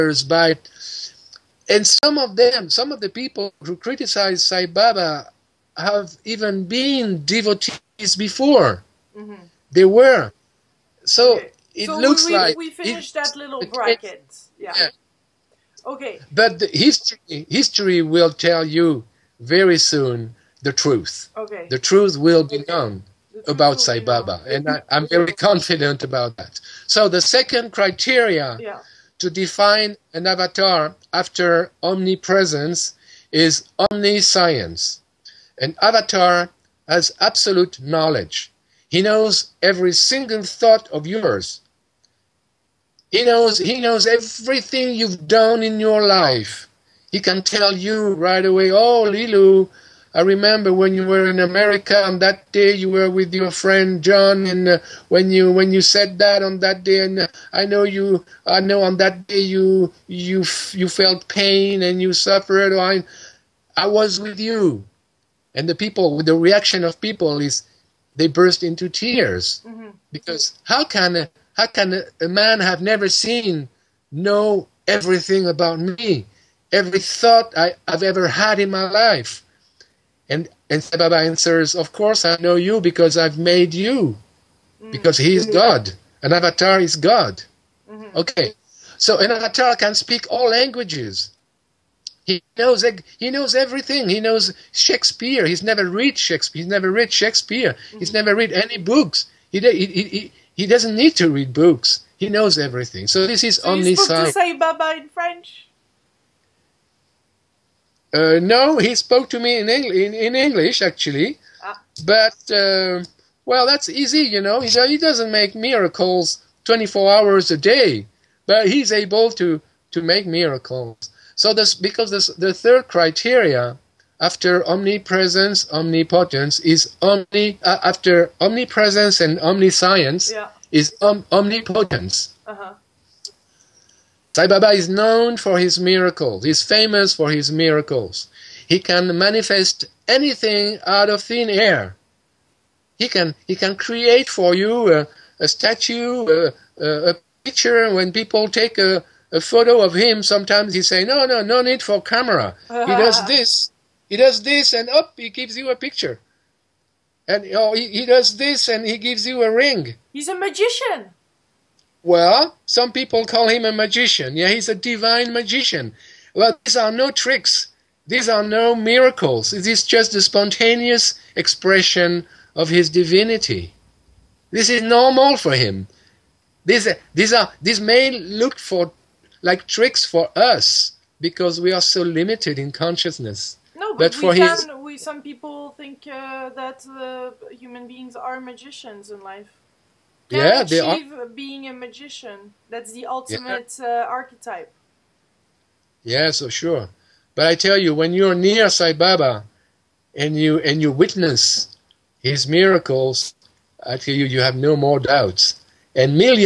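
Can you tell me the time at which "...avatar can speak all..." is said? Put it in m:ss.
1:29.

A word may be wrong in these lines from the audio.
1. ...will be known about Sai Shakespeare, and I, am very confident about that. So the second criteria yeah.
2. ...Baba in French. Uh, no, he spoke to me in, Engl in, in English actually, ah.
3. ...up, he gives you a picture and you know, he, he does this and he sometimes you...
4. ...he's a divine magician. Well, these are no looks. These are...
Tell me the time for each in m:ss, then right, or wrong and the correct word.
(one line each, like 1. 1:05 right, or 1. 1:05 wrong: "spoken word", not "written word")
1. 0:22 wrong: "Baba", not "Shakespeare"
2. 1:44 right
3. 2:34 wrong: "gives", not "sometimes"
4. 2:44 wrong: "tricks", not "looks".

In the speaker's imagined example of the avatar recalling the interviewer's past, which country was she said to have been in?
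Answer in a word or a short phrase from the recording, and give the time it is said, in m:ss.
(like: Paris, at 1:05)
America, at 0:51.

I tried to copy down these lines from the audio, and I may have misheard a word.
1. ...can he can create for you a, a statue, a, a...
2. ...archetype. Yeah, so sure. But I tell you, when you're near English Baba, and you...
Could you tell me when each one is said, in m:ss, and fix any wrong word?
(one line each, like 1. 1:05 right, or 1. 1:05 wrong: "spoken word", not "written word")
1. 2:23 right
2. 3:14 wrong: "Sai", not "English".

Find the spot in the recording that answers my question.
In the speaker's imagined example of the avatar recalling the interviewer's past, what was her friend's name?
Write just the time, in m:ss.
0:54.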